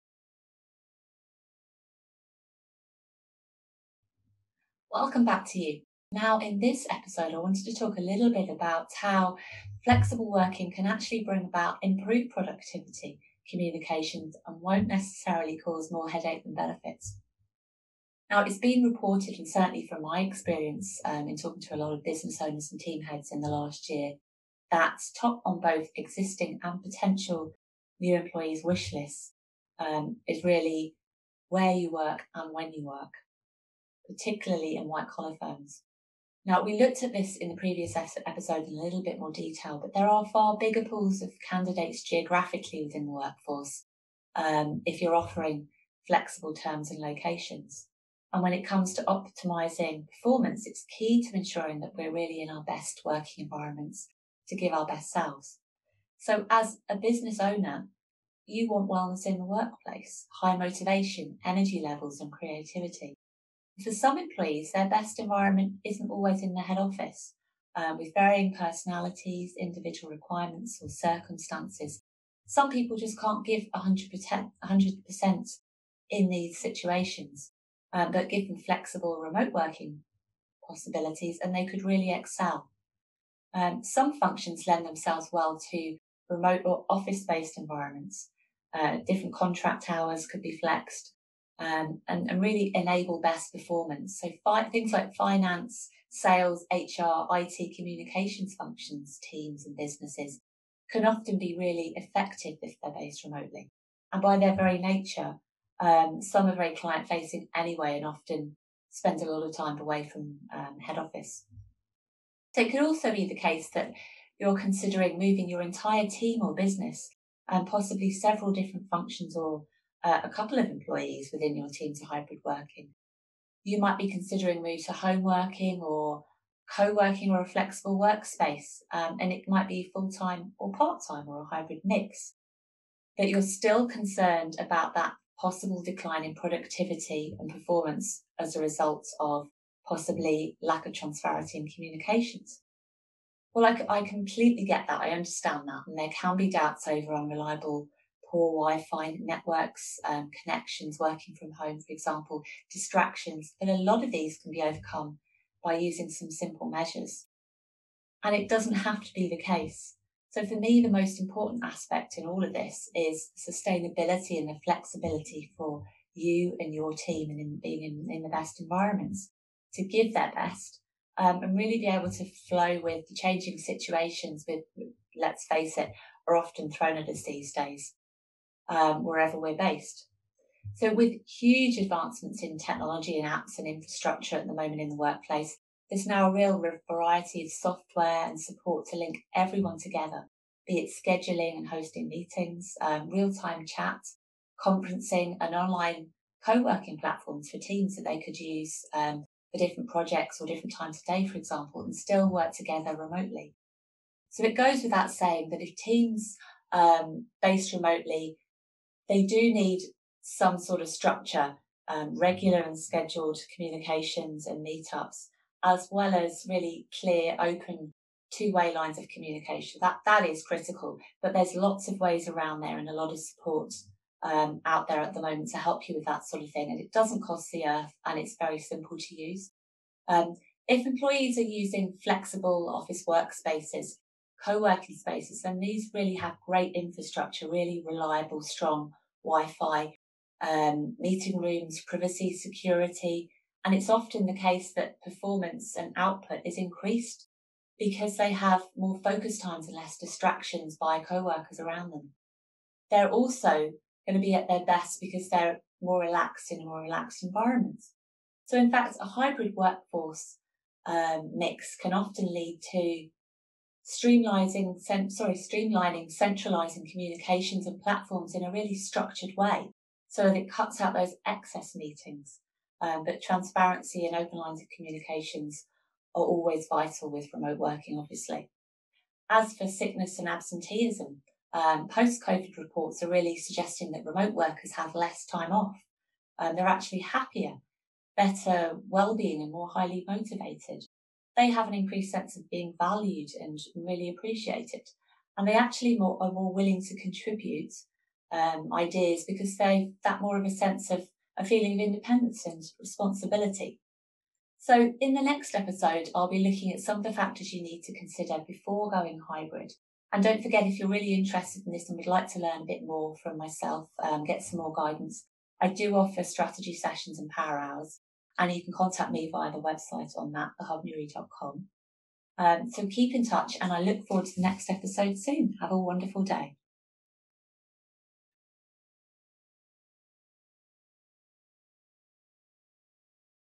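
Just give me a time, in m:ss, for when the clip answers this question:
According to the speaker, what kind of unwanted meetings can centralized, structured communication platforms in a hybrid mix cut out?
4:31.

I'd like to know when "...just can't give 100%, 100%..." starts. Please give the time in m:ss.
1:12.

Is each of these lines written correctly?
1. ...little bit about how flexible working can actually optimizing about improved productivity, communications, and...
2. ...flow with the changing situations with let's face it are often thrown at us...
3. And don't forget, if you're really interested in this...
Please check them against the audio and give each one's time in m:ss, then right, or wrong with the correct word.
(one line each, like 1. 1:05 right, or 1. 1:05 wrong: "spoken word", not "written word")
1. 0:08 wrong: "bring", not "optimizing"
2. 2:52 right
3. 5:10 right.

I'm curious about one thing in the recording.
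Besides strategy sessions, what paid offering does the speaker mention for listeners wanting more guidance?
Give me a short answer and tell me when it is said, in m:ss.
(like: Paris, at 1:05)
Power hours, at 5:17.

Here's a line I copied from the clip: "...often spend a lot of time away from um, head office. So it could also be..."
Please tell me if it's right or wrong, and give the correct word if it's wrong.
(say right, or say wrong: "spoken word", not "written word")
right.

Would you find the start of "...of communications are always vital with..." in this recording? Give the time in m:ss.
4:34.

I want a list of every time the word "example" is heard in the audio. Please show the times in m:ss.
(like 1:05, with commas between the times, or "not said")
2:31, 3:21.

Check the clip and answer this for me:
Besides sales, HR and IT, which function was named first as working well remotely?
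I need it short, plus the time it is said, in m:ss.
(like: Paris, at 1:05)
Finance, at 1:35.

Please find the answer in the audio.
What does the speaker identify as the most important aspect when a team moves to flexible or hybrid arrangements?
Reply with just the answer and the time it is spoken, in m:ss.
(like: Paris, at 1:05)
Sustainability, at 2:43.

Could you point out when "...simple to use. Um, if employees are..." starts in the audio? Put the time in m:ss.
3:48.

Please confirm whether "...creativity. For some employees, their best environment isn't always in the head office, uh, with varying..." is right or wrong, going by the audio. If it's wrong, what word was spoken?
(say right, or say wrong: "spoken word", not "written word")
right.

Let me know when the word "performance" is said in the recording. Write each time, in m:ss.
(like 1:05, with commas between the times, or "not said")
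0:50, 1:33, 2:17, 4:05.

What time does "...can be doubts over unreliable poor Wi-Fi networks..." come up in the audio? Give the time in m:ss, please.
2:26.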